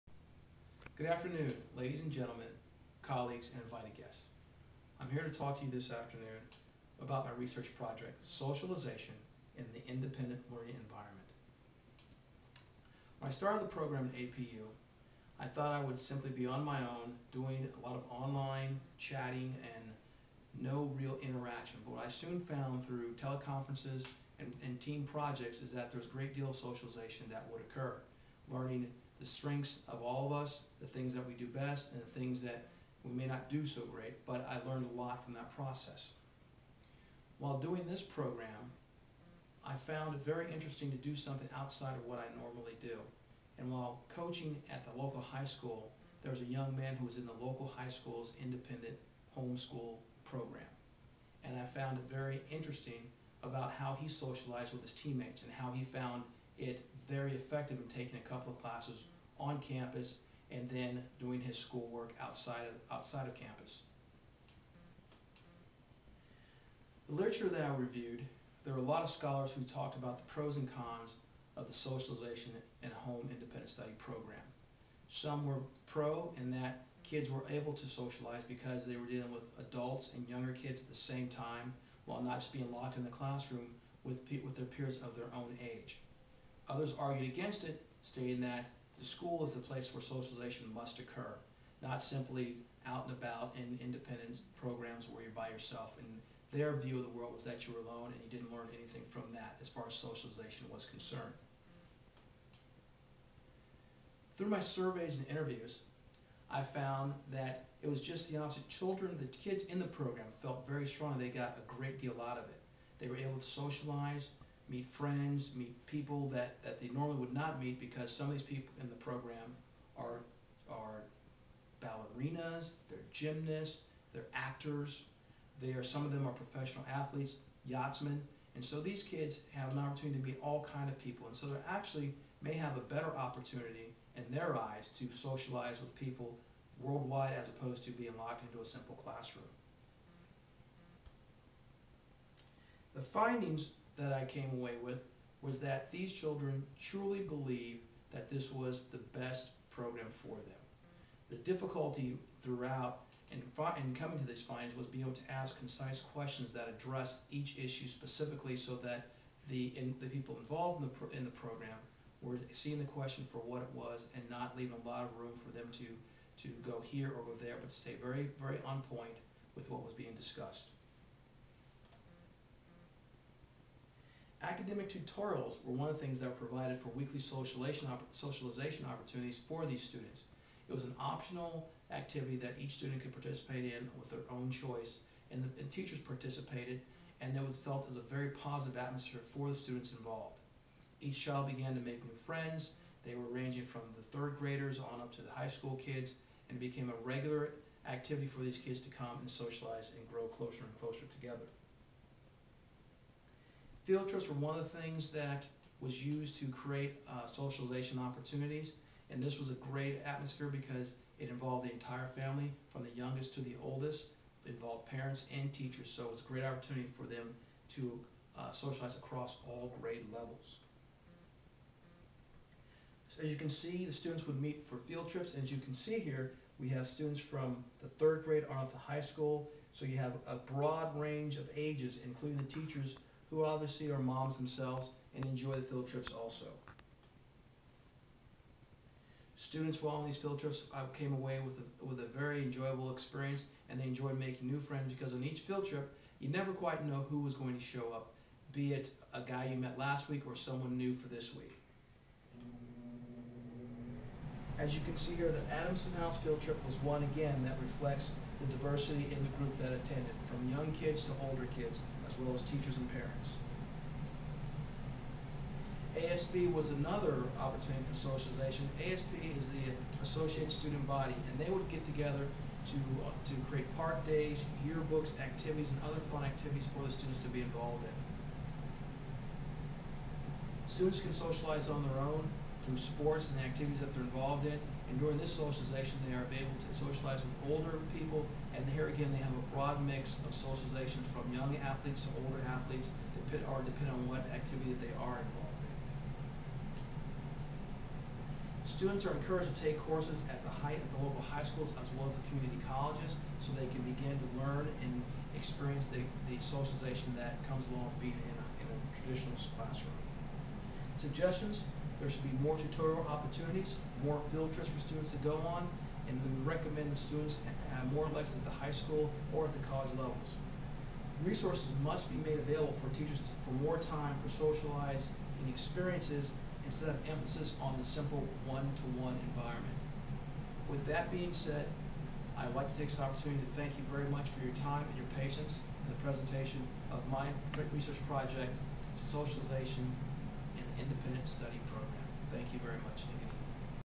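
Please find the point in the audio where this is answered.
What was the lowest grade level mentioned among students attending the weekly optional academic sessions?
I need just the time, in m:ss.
3:14.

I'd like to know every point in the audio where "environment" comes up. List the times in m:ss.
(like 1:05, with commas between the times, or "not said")
0:10, 5:29.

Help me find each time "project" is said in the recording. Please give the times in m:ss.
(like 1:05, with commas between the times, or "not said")
0:07, 0:25, 5:38.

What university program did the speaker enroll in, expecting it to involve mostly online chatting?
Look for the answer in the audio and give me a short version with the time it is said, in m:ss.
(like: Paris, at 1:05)
APU, at 0:14.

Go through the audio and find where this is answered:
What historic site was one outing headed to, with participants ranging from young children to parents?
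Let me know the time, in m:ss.
4:15.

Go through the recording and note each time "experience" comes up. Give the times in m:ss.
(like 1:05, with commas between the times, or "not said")
4:02, 5:05, 5:25.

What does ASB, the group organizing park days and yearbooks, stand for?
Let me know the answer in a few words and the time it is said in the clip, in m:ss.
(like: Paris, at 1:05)
Associate Student Body, at 4:30.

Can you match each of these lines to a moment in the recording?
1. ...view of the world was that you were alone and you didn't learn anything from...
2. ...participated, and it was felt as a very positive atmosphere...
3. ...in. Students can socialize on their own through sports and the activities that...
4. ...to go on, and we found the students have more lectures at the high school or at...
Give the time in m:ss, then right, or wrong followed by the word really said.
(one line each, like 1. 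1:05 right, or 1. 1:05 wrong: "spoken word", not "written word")
1. 1:36 right
2. 3:05 right
3. 4:37 right
4. 5:15 wrong: "recommend", not "found".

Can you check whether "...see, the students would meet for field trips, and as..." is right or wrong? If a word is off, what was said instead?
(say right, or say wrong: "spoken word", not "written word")
right.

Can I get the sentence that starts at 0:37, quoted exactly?
While doing this program, I found it very interesting to do something outside of what I normally do.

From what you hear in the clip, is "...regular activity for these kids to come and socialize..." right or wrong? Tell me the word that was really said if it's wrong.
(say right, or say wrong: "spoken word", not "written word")
right.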